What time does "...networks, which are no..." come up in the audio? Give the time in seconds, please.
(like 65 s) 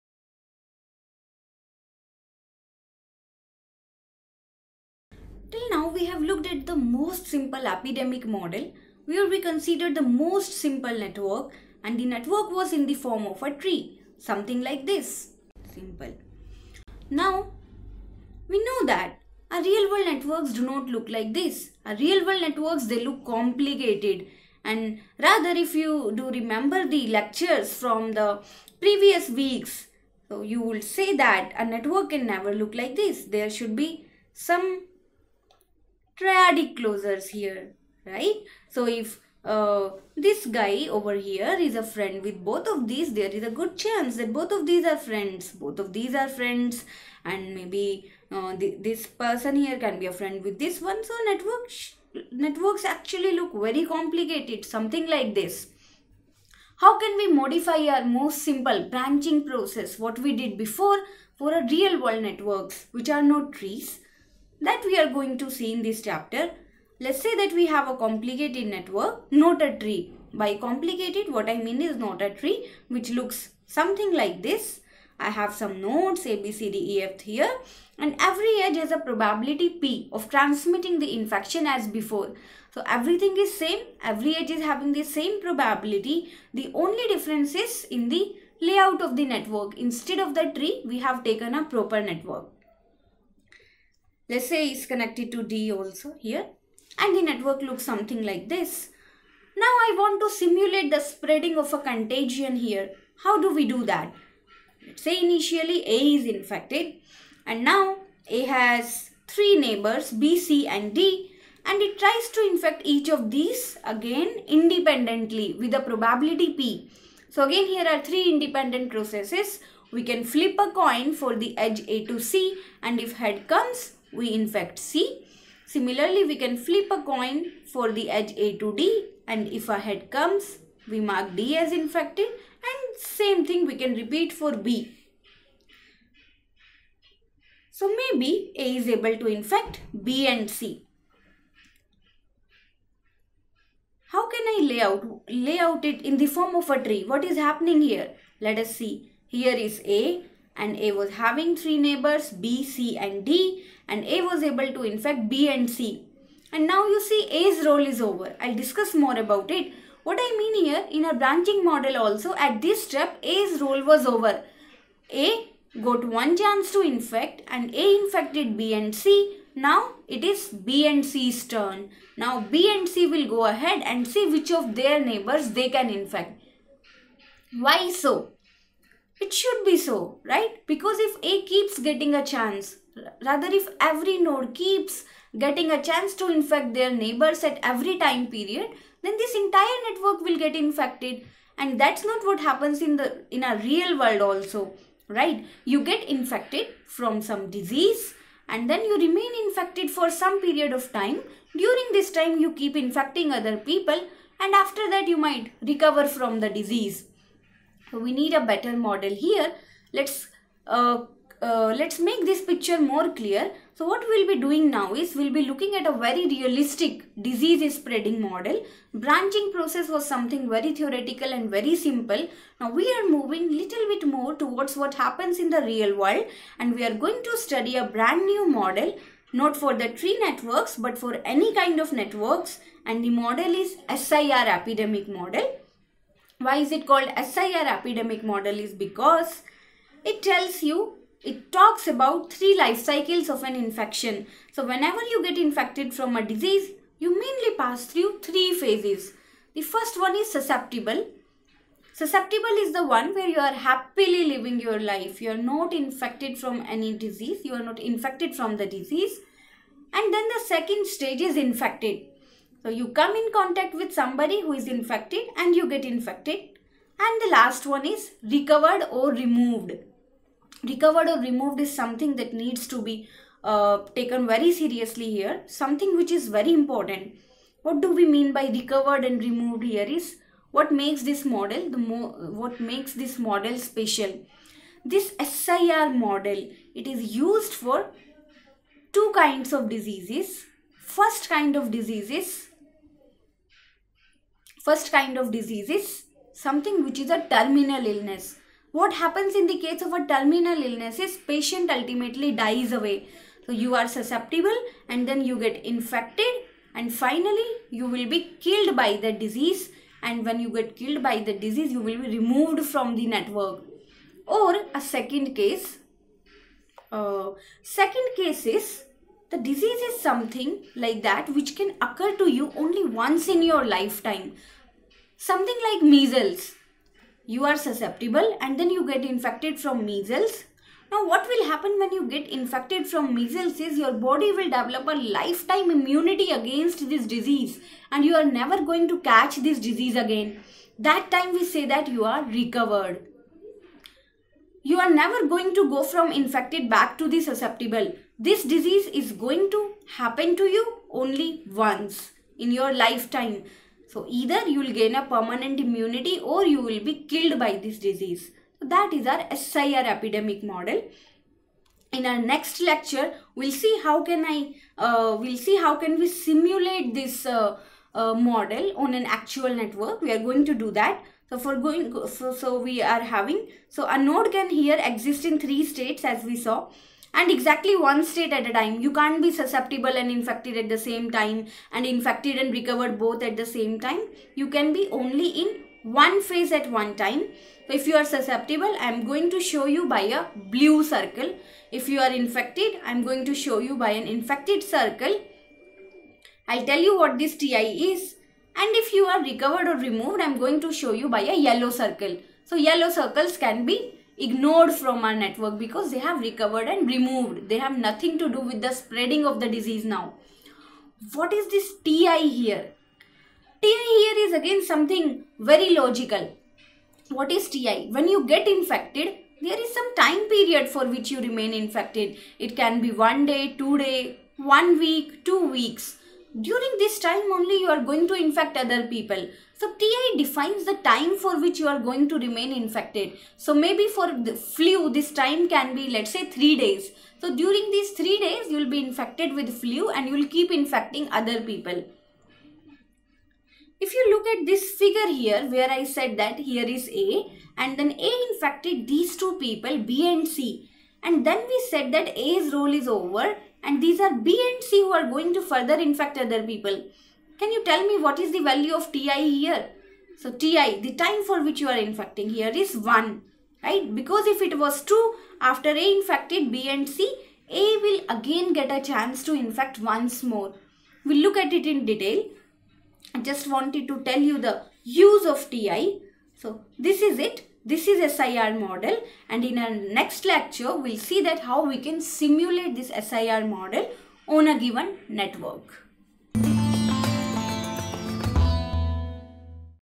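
62 s.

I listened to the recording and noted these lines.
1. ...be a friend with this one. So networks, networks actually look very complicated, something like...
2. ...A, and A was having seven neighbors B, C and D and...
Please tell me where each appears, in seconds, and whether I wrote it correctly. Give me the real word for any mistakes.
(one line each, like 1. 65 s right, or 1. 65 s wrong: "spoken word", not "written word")
1. 50 s right
2. 149 s wrong: "three", not "seven".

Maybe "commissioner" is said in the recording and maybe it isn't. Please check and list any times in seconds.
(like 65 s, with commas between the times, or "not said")
not said.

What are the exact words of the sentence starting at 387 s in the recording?
So if you are susceptible, I am going to show you by a blue circle.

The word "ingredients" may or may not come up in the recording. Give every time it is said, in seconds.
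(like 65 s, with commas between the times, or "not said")
not said.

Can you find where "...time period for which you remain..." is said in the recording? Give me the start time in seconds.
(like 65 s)
419 s.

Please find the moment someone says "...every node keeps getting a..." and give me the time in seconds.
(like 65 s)
183 s.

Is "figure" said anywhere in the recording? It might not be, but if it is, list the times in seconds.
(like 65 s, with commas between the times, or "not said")
444 s.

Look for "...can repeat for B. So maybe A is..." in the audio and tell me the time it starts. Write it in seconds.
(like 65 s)
133 s.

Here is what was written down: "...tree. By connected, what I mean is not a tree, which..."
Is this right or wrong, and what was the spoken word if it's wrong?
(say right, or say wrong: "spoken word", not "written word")
wrong: "complicated", not "connected".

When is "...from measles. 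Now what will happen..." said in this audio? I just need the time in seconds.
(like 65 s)
329 s.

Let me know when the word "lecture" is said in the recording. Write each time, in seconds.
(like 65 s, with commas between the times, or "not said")
27 s, 362 s, 480 s.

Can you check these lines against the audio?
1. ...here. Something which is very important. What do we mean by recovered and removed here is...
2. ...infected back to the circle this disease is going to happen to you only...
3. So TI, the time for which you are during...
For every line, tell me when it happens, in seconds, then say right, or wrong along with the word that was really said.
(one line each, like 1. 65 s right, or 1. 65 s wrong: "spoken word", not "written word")
1. 275 s right
2. 346 s wrong: "susceptible", not "circle"
3. 460 s wrong: "infecting", not "during".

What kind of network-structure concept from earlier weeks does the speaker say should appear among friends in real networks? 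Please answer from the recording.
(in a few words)
triadic closures.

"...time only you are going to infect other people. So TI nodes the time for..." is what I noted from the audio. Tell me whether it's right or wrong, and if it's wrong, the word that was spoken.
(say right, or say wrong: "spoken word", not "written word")
wrong: "defines", not "nodes".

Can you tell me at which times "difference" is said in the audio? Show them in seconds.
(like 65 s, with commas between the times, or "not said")
87 s.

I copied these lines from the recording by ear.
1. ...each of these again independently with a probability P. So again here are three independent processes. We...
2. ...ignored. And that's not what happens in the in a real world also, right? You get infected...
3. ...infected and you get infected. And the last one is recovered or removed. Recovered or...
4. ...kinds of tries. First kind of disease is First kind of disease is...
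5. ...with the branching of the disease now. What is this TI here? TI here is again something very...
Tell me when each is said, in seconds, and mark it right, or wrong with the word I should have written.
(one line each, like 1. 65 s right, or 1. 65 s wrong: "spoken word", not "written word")
1. 112 s right
2. 190 s wrong: "infected", not "ignored"
3. 264 s right
4. 289 s wrong: "diseases", not "tries"
5. 408 s wrong: "spreading", not "branching".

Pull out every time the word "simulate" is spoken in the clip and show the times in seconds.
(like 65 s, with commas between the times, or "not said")
100 s, 366 s, 482 s.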